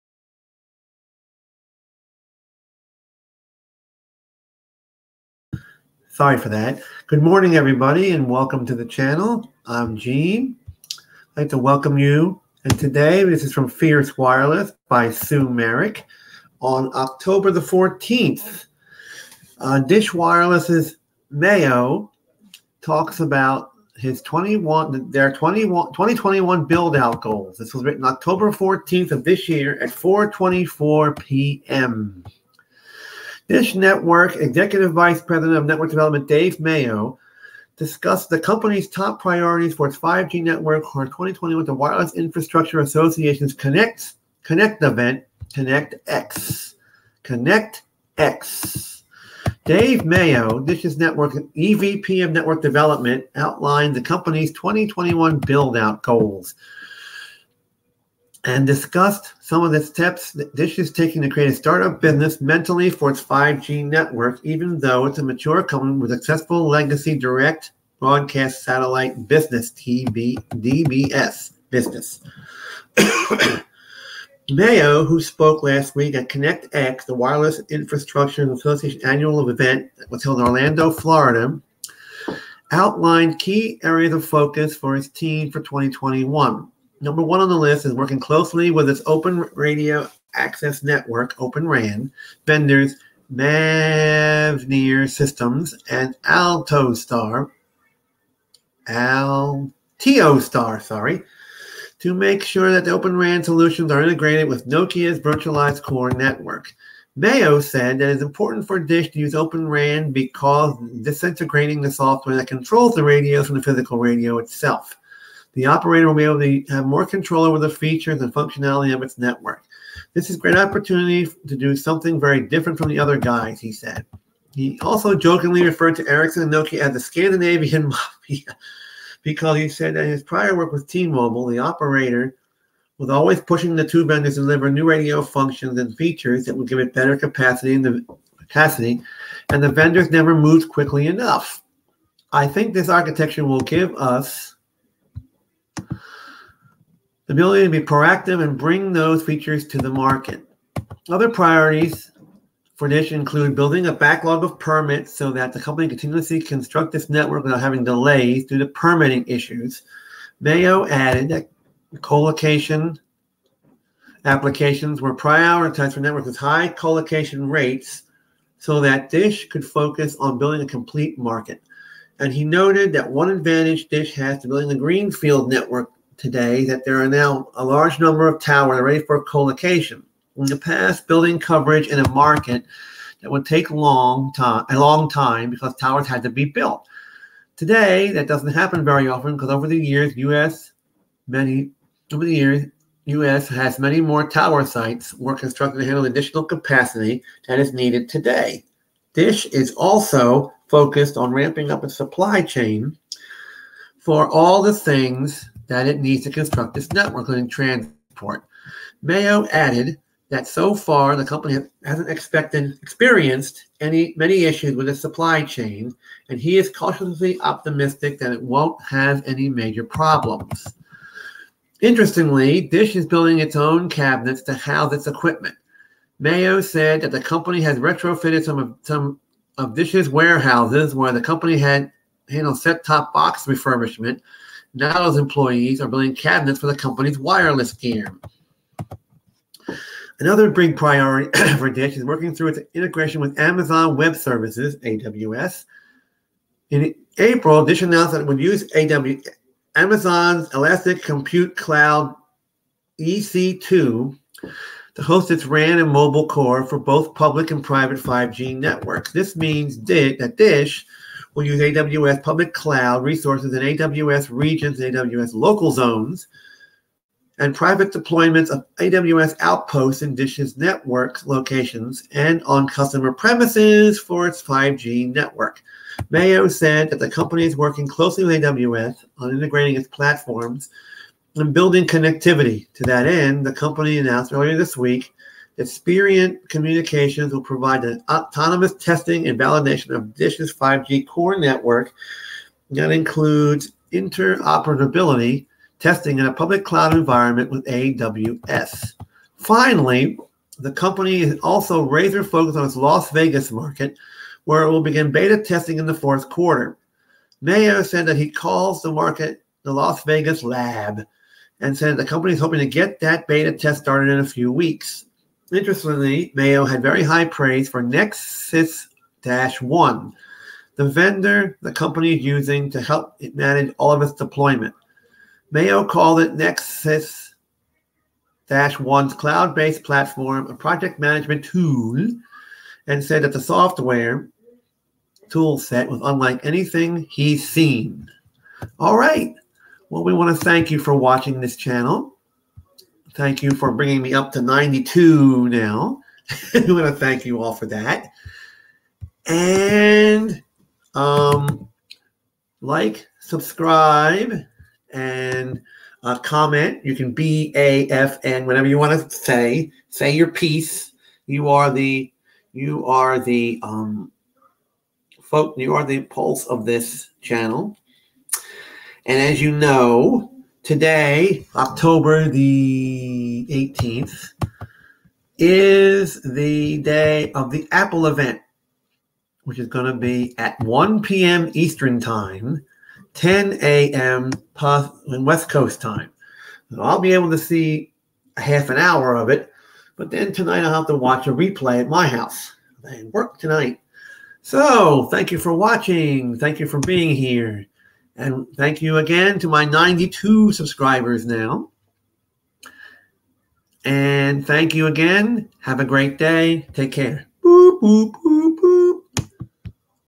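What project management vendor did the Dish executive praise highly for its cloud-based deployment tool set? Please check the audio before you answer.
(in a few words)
Nexus 1.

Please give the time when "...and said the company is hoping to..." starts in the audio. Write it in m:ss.
5:11.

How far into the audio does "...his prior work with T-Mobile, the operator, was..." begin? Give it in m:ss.
2:10.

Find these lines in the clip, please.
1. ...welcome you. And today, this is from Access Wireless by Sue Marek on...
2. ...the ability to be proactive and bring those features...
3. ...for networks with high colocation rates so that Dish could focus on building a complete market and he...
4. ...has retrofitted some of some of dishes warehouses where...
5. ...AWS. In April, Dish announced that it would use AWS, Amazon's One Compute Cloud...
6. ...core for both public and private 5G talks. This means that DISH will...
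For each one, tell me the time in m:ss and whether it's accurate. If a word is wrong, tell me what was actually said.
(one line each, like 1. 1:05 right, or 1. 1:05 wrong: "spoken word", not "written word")
1. 0:11 wrong: "Fierce", not "Access"
2. 2:25 right
3. 2:45 right
4. 3:47 right
5. 4:04 wrong: "Elastic", not "One"
6. 4:16 wrong: "networks", not "talks".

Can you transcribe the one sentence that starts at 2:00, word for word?
This is a great opportunity to do something very different from the other guys, he said.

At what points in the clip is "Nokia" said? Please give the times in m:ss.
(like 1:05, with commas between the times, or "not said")
1:44, 2:06.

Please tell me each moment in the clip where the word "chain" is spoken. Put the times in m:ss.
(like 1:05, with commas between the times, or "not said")
3:22, 3:35.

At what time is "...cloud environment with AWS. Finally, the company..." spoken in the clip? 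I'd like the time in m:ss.
4:56.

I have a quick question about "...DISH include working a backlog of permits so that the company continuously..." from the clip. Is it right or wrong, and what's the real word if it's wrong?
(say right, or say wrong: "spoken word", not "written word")
wrong: "building", not "working".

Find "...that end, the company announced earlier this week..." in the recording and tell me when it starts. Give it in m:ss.
4:42.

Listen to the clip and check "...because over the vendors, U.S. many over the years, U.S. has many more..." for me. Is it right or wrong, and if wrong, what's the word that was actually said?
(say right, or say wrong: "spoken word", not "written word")
wrong: "years", not "vendors".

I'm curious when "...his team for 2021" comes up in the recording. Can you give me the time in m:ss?
1:24.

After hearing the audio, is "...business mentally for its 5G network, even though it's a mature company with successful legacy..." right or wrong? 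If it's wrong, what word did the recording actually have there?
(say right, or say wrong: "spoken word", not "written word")
right.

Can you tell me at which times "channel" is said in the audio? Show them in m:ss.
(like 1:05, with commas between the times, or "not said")
0:08, 5:41, 6:07.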